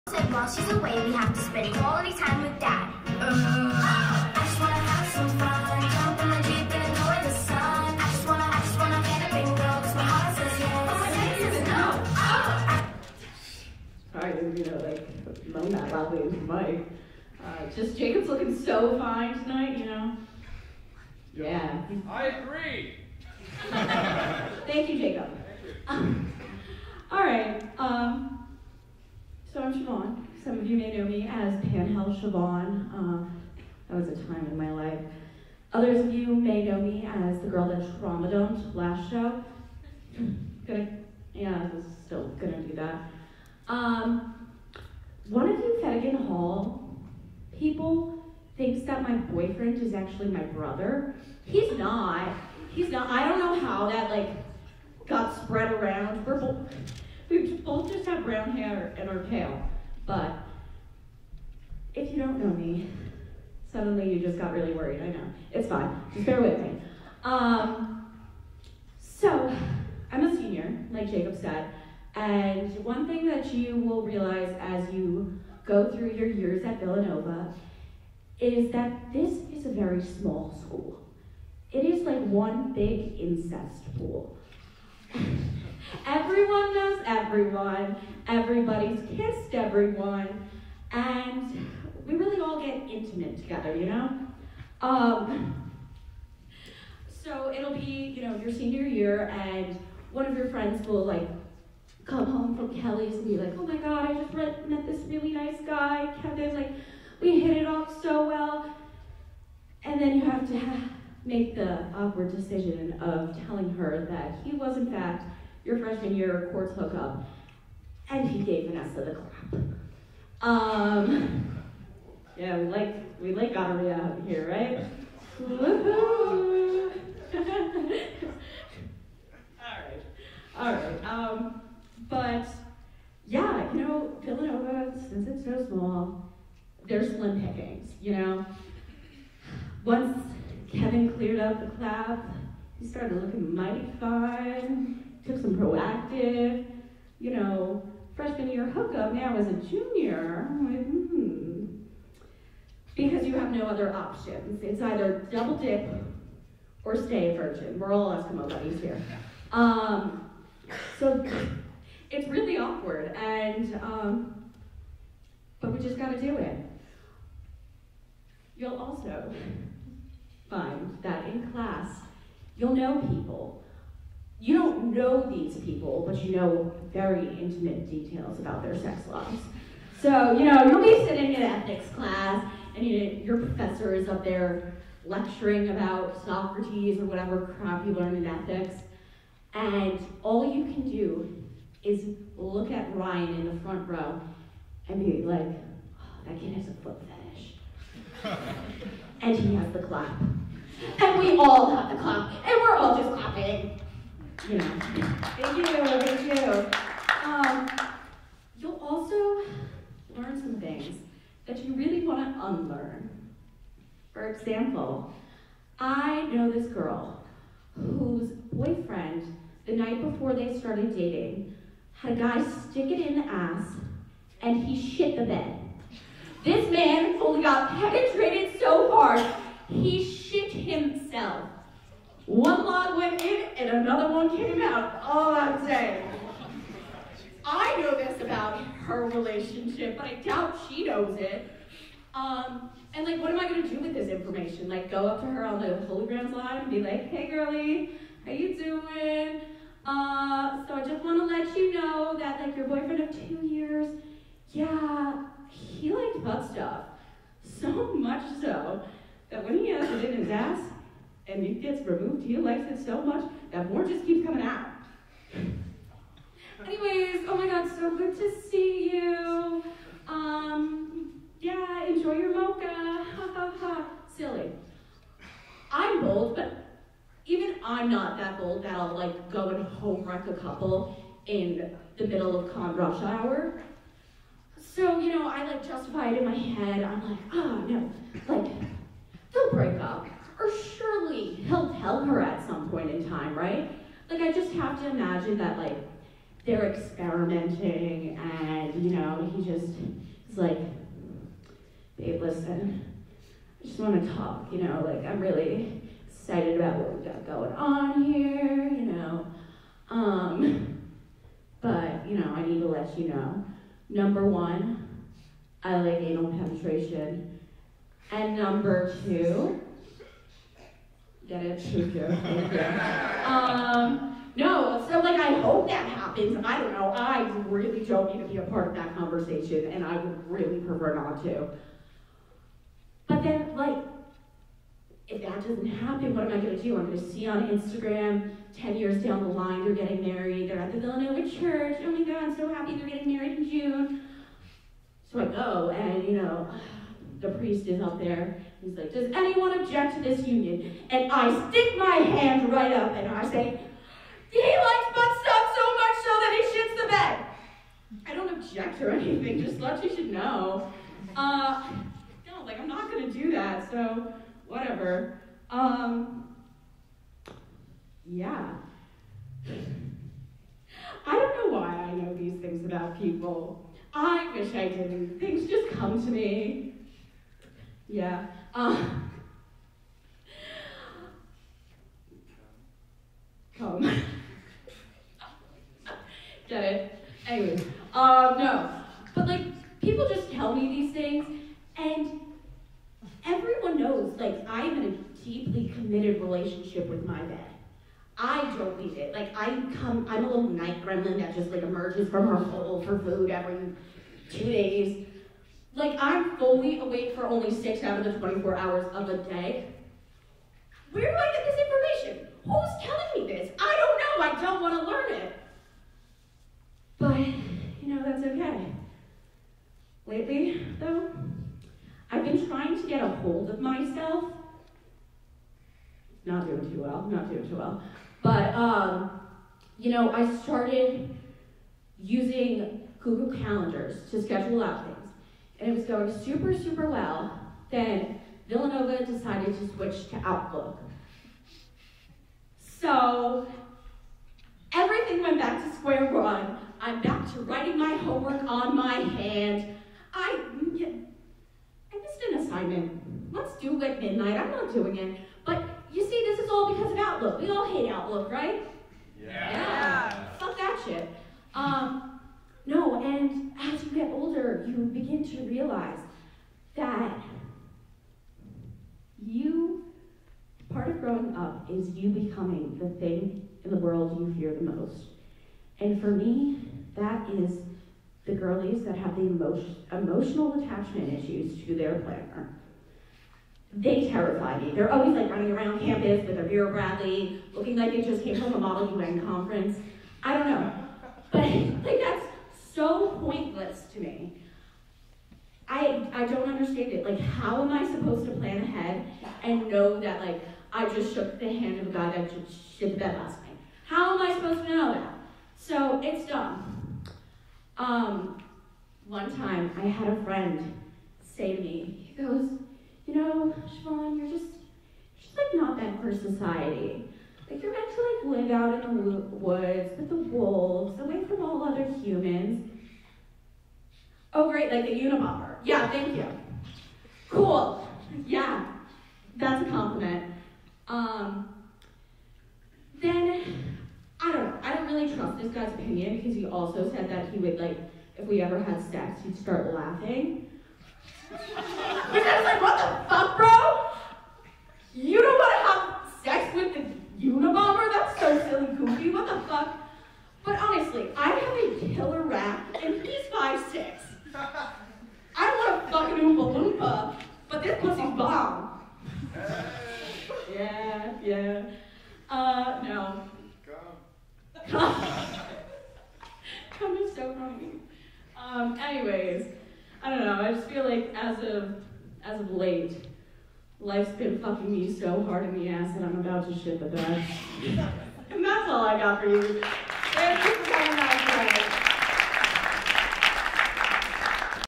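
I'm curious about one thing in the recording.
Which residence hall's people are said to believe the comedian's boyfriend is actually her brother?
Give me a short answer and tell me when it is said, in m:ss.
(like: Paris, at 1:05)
Fagin Hall, at 0:45.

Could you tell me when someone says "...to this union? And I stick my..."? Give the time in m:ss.
5:49.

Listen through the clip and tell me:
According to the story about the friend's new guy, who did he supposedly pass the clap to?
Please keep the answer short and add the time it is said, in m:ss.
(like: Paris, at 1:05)
Vanessa, at 1:58.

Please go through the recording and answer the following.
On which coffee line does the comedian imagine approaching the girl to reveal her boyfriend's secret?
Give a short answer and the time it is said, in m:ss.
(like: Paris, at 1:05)
Holy Grounds, at 4:05.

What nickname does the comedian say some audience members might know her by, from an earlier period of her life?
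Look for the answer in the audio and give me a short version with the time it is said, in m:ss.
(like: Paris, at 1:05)
Panhell Siobhan, at 0:31.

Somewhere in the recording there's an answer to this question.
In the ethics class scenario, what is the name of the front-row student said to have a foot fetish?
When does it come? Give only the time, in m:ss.
3:12.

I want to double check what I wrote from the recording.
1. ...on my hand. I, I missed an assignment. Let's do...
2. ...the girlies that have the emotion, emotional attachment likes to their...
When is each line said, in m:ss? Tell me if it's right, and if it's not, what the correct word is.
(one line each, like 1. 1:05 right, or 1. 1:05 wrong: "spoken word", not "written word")
1. 7:28 right
2. 7:58 wrong: "issues", not "likes".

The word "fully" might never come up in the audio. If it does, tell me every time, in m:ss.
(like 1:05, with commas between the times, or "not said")
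3:47, 6:46.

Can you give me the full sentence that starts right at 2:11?
Um, but yeah, you know, Villanova, since it's so small, there's slim pickings.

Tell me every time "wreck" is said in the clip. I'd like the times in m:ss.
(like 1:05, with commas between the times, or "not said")
4:40.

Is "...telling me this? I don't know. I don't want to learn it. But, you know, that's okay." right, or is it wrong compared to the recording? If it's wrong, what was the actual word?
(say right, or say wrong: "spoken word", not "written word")
right.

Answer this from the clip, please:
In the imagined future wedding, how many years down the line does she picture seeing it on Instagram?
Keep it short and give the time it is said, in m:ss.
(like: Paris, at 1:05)
10, at 5:38.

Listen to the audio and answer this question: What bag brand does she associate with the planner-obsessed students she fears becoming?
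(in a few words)
Vera Bradley.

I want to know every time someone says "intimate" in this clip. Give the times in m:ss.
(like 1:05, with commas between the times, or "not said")
1:32, 2:57.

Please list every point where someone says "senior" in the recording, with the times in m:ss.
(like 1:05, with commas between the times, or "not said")
1:10, 1:38.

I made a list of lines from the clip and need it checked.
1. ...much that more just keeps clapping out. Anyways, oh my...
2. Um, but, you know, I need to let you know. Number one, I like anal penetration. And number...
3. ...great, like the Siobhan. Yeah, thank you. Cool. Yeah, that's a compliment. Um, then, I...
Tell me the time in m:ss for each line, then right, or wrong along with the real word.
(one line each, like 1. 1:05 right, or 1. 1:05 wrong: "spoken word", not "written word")
1. 4:23 wrong: "coming", not "clapping"
2. 5:09 right
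3. 8:44 wrong: "Unabomber", not "Siobhan".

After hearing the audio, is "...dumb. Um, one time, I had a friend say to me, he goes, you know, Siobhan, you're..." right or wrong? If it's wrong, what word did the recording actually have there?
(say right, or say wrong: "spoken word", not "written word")
right.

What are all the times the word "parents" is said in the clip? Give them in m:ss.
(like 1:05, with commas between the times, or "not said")
not said.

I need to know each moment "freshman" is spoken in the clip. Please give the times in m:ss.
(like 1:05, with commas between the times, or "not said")
1:55, 2:28.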